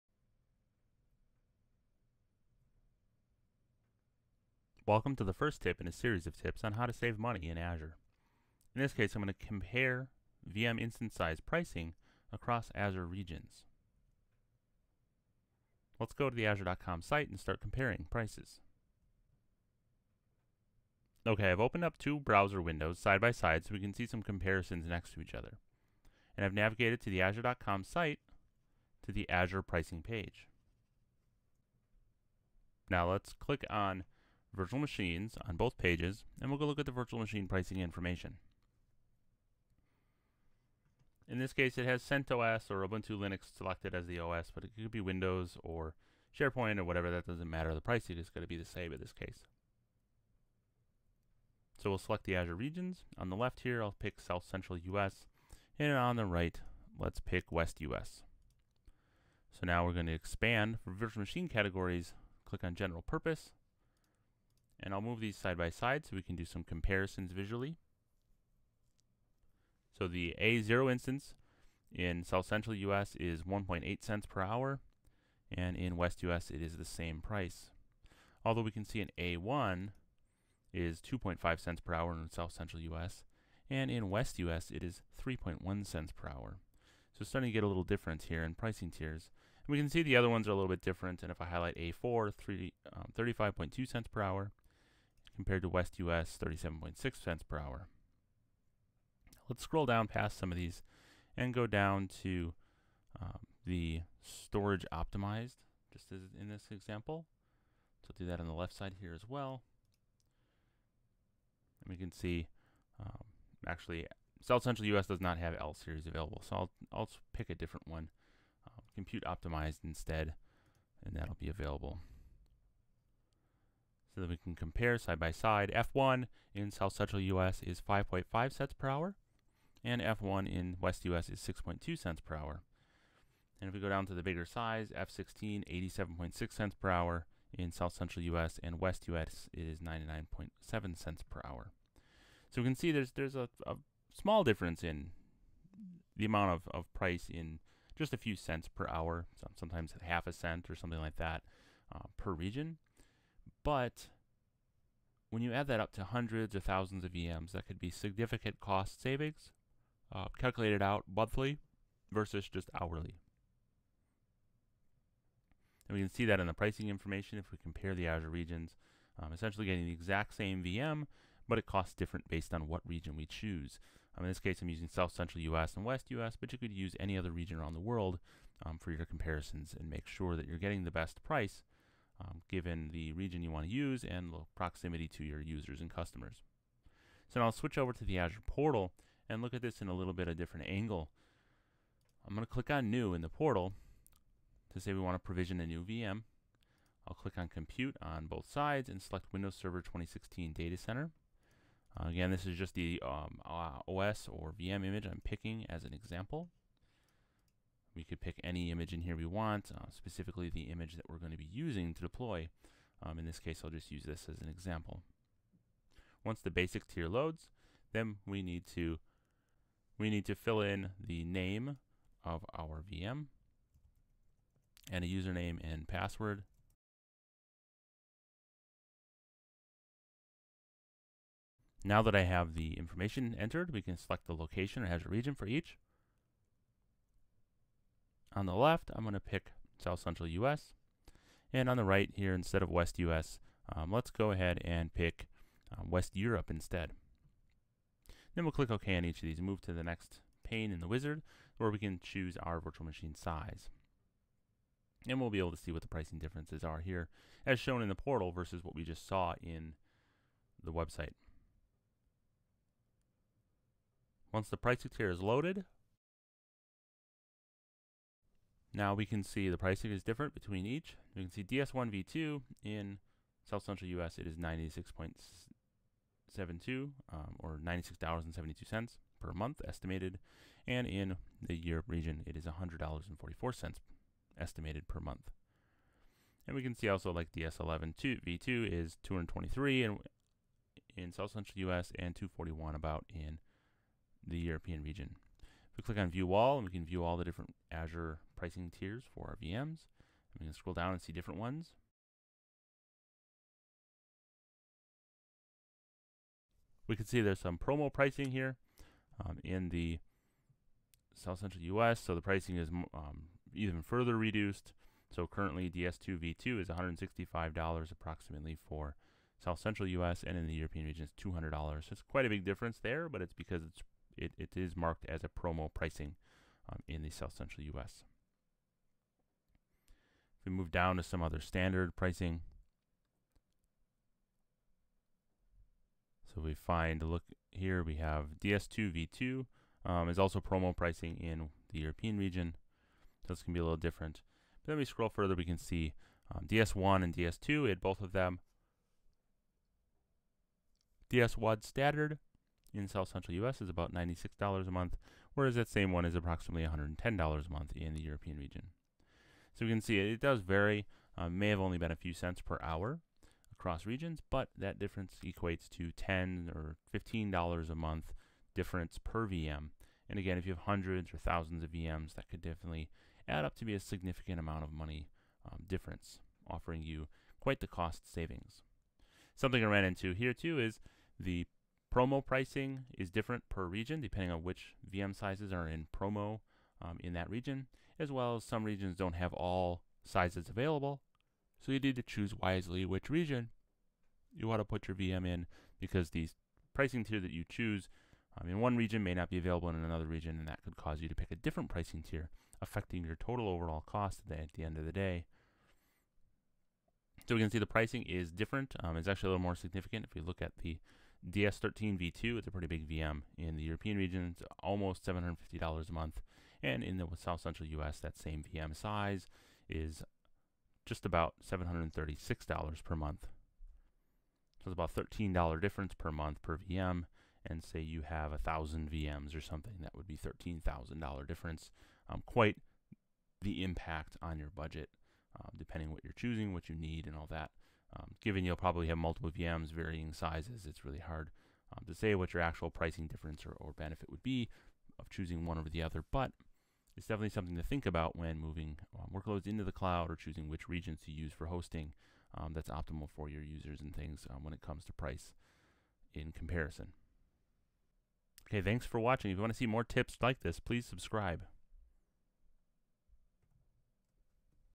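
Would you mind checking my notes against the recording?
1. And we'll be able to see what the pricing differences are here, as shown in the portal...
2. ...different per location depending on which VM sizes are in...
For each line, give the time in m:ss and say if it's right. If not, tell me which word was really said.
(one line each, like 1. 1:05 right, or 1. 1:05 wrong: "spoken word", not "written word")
1. 4:15 right
2. 6:23 wrong: "region", not "location".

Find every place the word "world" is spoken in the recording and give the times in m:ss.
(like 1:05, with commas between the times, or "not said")
2:57.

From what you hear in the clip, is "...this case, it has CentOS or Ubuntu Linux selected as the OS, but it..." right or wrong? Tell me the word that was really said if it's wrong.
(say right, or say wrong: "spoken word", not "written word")
right.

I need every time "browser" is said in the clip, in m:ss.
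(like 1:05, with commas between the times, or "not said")
0:22.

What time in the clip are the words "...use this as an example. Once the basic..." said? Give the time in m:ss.
3:33.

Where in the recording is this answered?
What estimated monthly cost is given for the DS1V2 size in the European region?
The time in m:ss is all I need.
4:42.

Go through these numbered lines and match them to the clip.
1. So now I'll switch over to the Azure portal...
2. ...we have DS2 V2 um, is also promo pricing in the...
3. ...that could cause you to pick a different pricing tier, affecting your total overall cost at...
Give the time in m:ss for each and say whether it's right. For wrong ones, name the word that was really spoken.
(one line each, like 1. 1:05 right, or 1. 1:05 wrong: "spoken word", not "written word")
1. 3:07 right
2. 5:37 right
3. 6:40 right.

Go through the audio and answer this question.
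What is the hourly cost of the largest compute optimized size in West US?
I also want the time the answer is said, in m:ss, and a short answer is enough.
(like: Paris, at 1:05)
99.7 cents per hour, at 2:19.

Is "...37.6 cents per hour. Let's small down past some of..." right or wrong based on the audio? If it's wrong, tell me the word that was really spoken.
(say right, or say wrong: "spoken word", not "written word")
wrong: "scroll", not "small".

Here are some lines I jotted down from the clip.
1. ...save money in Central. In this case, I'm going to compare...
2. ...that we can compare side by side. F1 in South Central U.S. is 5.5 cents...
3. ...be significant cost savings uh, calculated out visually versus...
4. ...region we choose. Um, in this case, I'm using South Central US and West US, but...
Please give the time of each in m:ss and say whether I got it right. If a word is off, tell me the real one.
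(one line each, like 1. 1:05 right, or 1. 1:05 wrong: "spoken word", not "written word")
1. 0:06 wrong: "Azure", not "Central"
2. 2:04 right
3. 2:37 wrong: "monthly", not "visually"
4. 2:52 right.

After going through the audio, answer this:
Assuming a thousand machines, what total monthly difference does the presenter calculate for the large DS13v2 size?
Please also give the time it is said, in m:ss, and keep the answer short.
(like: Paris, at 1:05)
$13,000, at 7:10.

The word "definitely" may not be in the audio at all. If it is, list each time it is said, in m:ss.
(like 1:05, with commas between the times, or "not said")
6:12, 7:27.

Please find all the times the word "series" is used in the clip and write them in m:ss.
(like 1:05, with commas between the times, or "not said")
0:05, 1:55.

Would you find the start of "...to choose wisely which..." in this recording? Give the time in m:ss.
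6:31.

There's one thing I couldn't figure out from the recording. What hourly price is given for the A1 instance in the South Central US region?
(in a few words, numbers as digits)
2.5 cents per hour.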